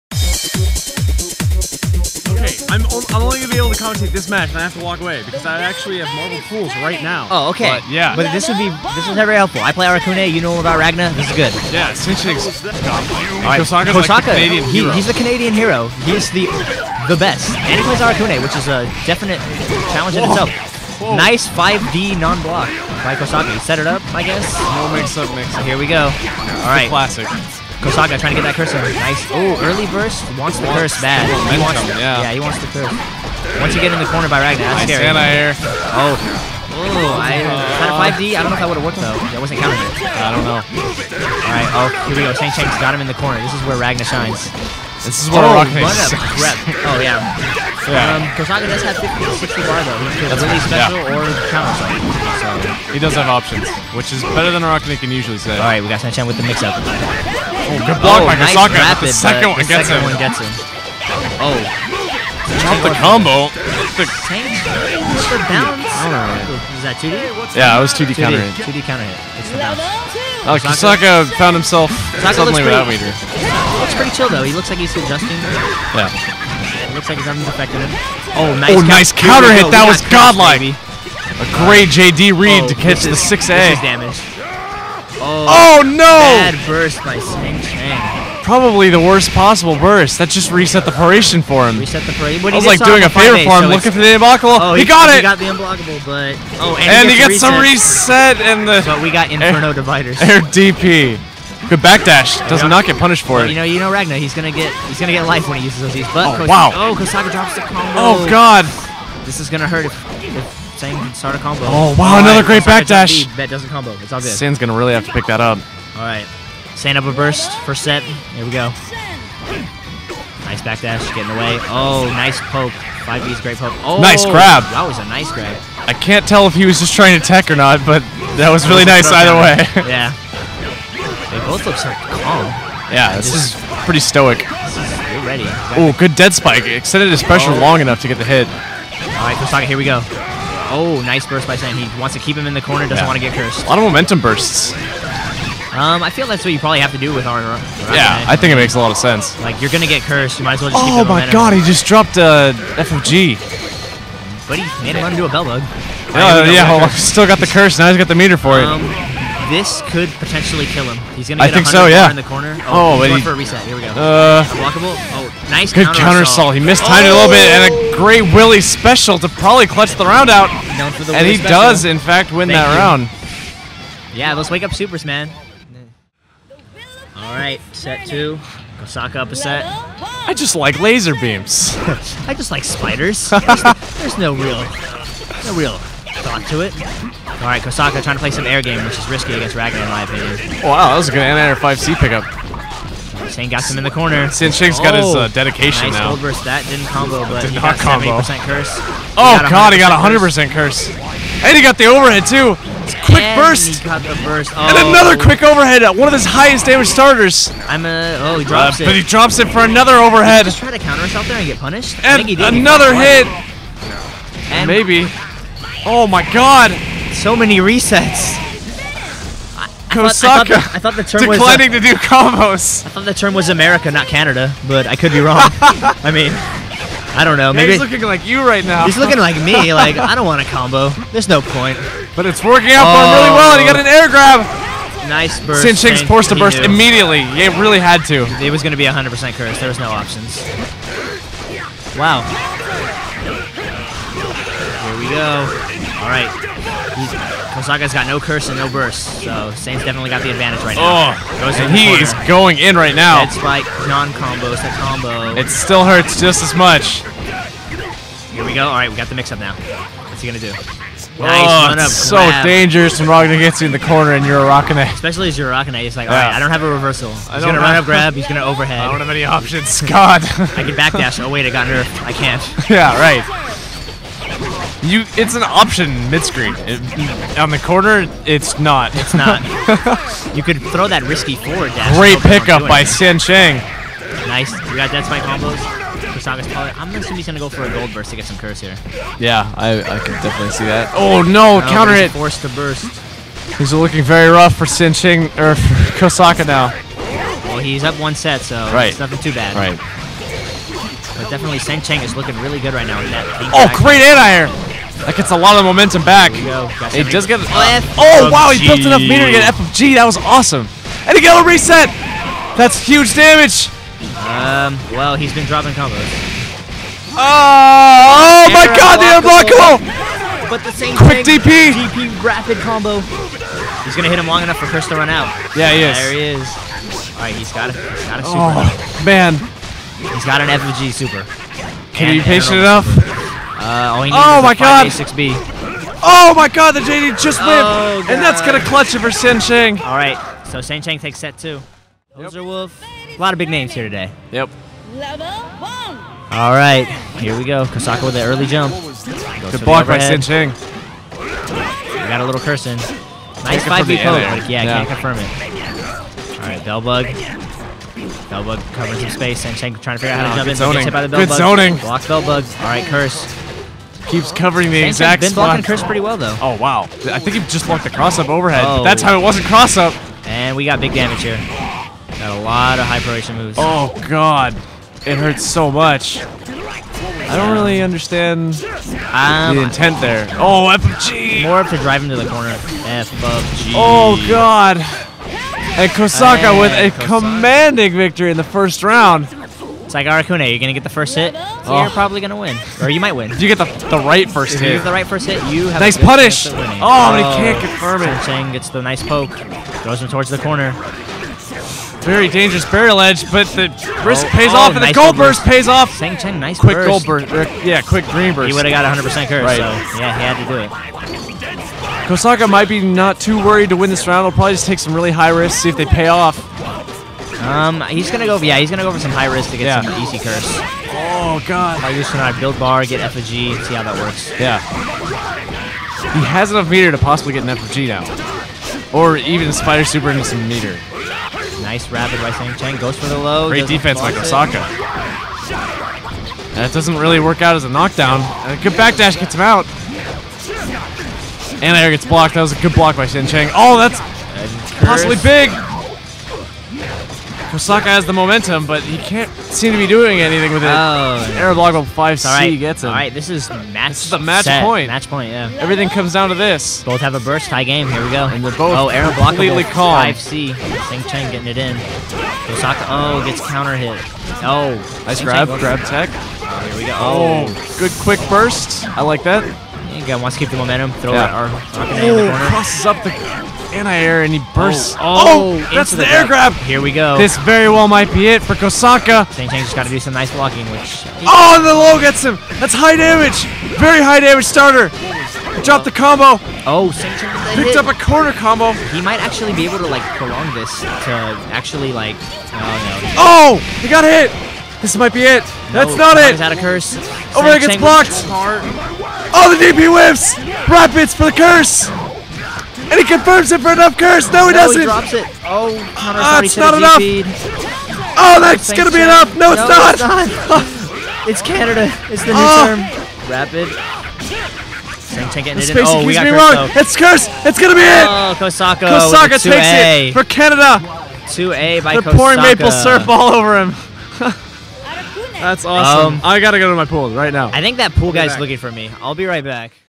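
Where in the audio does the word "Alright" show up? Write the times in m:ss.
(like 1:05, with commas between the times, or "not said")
0:41, 3:07, 4:06, 4:18, 5:27, 5:39, 5:46, 5:56.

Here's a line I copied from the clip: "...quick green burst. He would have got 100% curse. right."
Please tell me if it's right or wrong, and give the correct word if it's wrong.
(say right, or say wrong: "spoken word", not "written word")
right.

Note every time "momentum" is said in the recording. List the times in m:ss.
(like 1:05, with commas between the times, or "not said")
2:23, 5:05, 7:28, 7:50.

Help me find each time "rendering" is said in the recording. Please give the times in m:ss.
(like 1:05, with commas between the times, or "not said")
not said.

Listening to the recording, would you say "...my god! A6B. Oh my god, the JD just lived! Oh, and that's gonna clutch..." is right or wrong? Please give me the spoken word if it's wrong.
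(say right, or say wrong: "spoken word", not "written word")
right.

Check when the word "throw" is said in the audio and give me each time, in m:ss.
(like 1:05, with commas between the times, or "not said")
4:40, 6:39, 7:51.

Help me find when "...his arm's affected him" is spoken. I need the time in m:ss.
1:17.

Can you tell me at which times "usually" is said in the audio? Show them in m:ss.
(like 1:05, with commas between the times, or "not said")
0:55.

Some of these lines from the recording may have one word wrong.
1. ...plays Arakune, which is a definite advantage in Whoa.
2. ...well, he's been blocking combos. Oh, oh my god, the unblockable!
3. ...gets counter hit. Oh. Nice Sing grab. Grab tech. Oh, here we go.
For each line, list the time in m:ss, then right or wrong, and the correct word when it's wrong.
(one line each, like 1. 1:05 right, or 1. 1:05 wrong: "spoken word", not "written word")
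1. 0:17 wrong: "challenge", not "advantage"
2. 5:14 wrong: "dropping", not "blocking"
3. 7:43 right.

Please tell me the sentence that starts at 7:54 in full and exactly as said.
Oh, oh, oh that's the, the air grab.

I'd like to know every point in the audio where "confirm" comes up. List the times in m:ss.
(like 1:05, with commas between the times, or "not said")
5:54, 6:37, 8:23.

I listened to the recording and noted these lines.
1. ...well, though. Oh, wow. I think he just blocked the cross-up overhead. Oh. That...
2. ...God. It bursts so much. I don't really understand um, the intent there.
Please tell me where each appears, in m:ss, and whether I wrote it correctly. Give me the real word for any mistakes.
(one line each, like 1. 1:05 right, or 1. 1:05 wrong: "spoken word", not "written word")
1. 6:06 right
2. 6:14 wrong: "hurts", not "bursts".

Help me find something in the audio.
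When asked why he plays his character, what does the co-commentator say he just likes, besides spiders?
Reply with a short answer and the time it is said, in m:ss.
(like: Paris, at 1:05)
Laser beams, at 2:59.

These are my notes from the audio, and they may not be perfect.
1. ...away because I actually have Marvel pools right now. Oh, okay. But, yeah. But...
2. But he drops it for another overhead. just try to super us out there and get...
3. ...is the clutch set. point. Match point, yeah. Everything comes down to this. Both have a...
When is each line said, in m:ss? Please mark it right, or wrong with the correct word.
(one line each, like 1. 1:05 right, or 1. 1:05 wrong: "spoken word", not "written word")
1. 0:05 right
2. 3:28 wrong: "counter", not "super"
3. 7:34 wrong: "match", not "clutch".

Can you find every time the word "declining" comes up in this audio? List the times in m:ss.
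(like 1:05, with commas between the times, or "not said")
3:41.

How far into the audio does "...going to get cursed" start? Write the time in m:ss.
2:29.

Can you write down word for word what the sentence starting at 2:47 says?
great Willy special to probably clutch the round out.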